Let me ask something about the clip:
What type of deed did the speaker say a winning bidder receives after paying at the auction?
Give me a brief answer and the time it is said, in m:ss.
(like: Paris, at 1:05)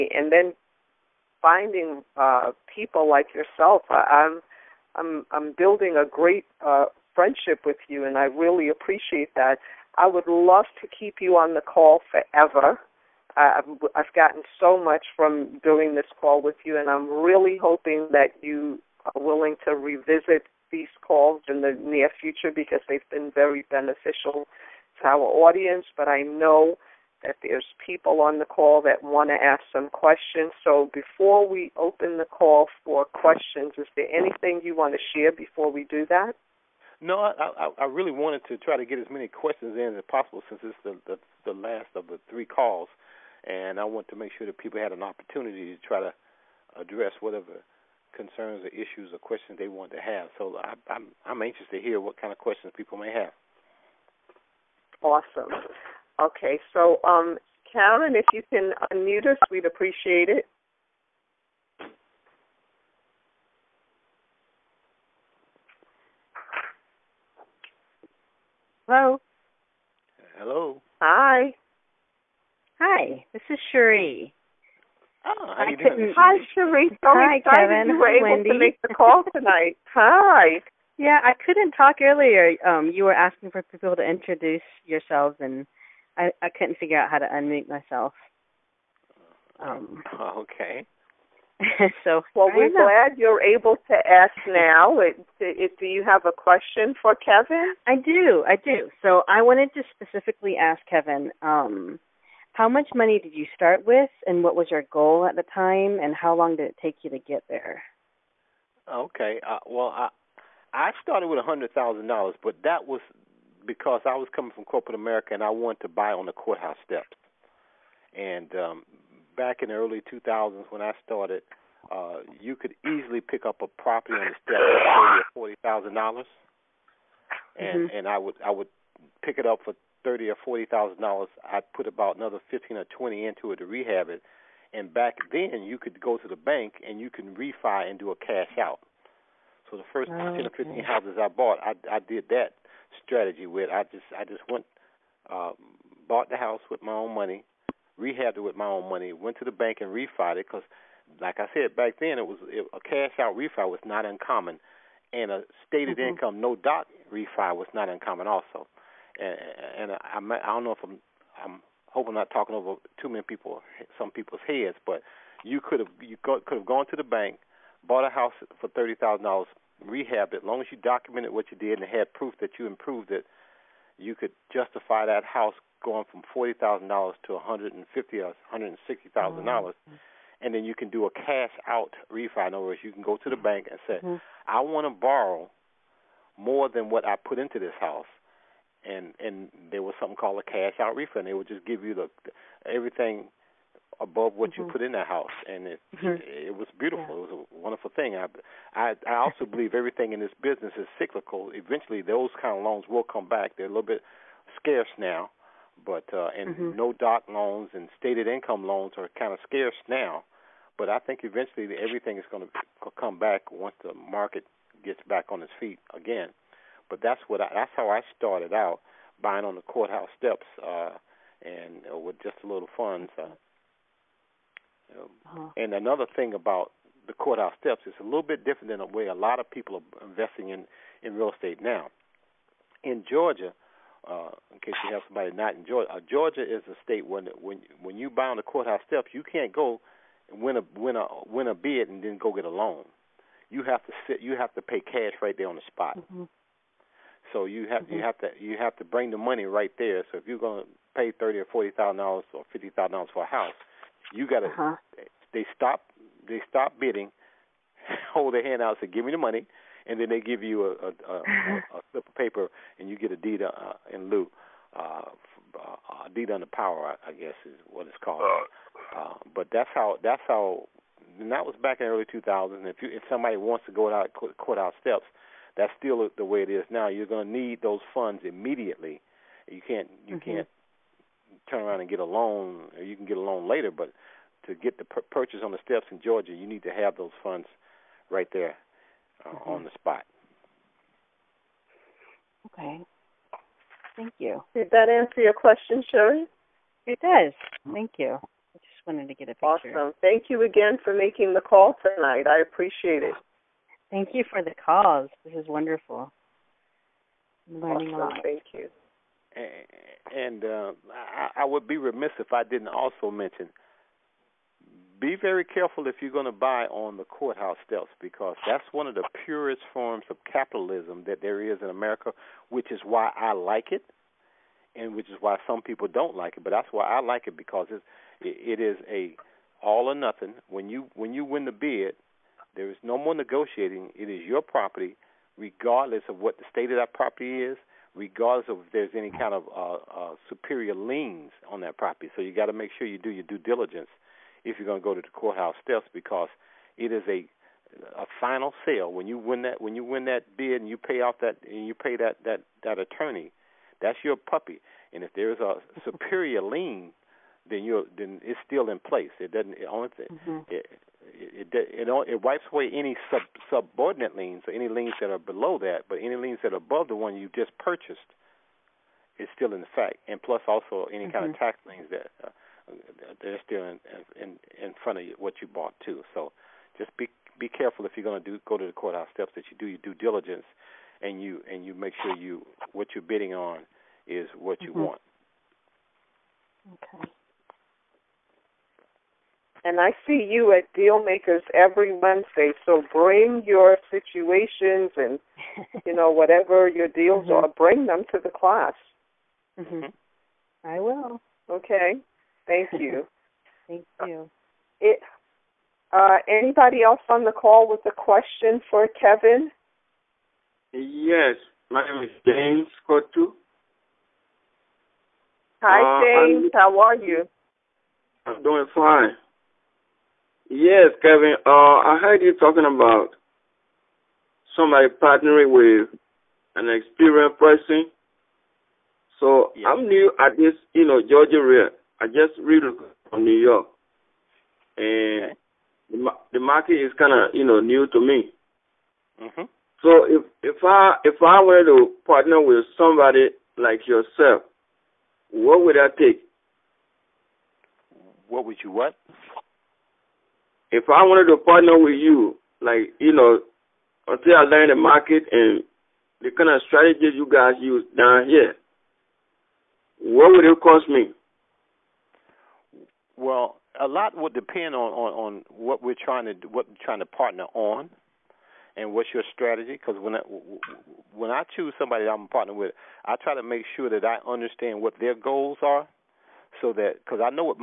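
deed under power, at 4:26.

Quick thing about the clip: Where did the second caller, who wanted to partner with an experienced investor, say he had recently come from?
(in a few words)
New York.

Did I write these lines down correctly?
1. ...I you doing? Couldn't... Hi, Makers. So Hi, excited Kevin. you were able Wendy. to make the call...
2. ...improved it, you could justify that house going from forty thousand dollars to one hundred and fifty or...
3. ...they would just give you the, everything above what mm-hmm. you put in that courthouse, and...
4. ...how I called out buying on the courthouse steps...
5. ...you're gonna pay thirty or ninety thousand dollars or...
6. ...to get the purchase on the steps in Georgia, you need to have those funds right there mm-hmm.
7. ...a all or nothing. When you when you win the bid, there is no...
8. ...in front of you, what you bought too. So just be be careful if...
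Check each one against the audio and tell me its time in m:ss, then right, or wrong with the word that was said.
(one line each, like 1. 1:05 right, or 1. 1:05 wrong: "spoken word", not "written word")
1. 1:15 wrong: "Cherie", not "Makers"
2. 2:52 right
3. 3:11 wrong: "house", not "courthouse"
4. 3:37 wrong: "started", not "called"
5. 4:10 wrong: "forty", not "ninety"
6. 4:44 right
7. 5:28 right
8. 6:14 right.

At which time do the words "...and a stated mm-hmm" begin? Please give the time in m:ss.
2:35.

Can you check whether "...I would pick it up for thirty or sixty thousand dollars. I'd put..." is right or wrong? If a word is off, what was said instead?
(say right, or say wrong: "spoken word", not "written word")
wrong: "forty", not "sixty".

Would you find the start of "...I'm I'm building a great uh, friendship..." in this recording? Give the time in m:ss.
0:04.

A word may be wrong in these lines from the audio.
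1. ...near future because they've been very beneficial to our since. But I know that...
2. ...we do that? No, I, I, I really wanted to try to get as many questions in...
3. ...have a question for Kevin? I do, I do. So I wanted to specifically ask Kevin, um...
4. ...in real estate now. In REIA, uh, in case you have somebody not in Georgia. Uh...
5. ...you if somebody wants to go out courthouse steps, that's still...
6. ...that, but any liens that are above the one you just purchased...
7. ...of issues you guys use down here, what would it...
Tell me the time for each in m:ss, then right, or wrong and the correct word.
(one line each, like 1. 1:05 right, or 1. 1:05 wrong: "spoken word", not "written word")
1. 0:21 wrong: "audience", not "since"
2. 0:35 right
3. 1:36 right
4. 3:51 wrong: "Georgia", not "REIA"
5. 4:32 right
6. 6:05 right
7. 7:36 wrong: "strategies", not "issues".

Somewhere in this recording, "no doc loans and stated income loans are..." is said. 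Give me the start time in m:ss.
3:26.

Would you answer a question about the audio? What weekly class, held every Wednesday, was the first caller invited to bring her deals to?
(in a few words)
Deal Makers.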